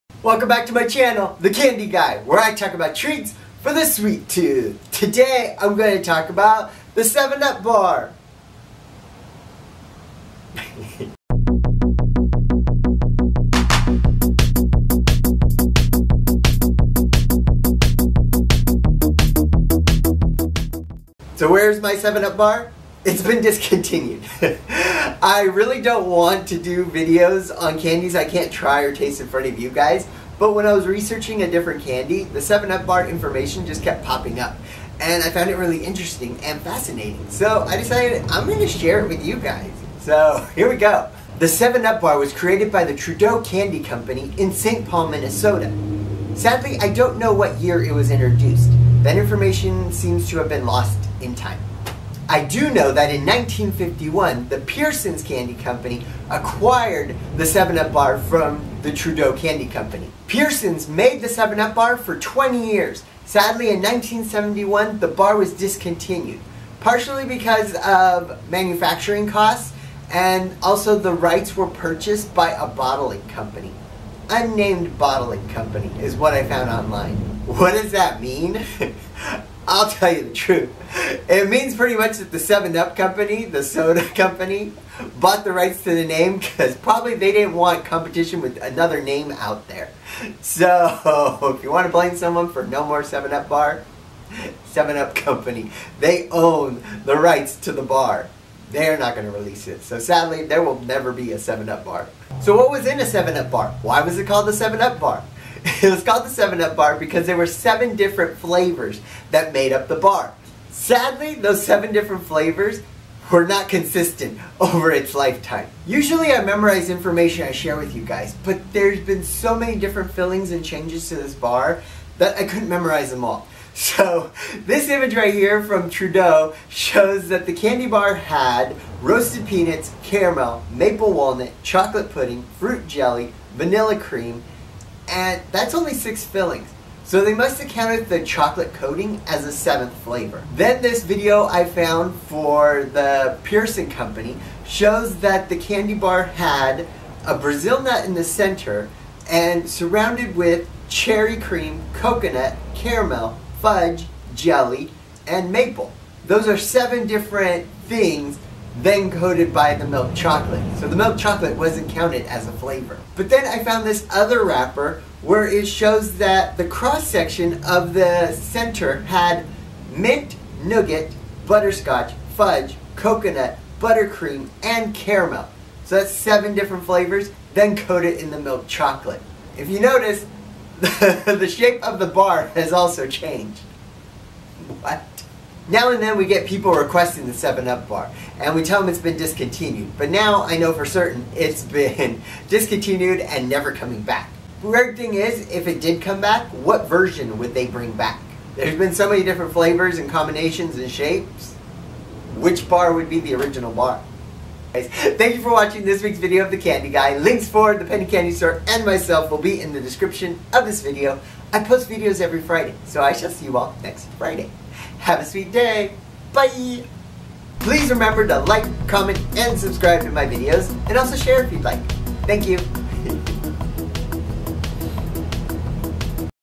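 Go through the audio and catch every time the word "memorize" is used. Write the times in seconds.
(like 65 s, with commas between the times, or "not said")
116 s, 122 s.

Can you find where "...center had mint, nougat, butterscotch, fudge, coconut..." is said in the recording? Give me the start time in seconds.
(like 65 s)
168 s.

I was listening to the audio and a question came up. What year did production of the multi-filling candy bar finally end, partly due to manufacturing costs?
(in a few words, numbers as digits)
1971.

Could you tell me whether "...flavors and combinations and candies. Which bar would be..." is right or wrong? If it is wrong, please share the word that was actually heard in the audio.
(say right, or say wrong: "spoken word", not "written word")
wrong: "shapes", not "candies".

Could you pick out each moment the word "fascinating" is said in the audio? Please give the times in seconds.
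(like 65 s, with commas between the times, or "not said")
36 s.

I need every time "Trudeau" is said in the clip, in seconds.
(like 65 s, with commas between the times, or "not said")
42 s, 58 s, 125 s.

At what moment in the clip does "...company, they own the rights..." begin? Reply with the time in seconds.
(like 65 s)
95 s.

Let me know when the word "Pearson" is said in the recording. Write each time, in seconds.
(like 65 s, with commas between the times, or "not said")
54 s, 60 s, 143 s.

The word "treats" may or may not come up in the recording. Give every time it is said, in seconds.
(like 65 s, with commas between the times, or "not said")
2 s.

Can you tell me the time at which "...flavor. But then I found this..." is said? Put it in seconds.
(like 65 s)
162 s.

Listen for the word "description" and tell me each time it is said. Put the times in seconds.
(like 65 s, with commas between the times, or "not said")
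209 s.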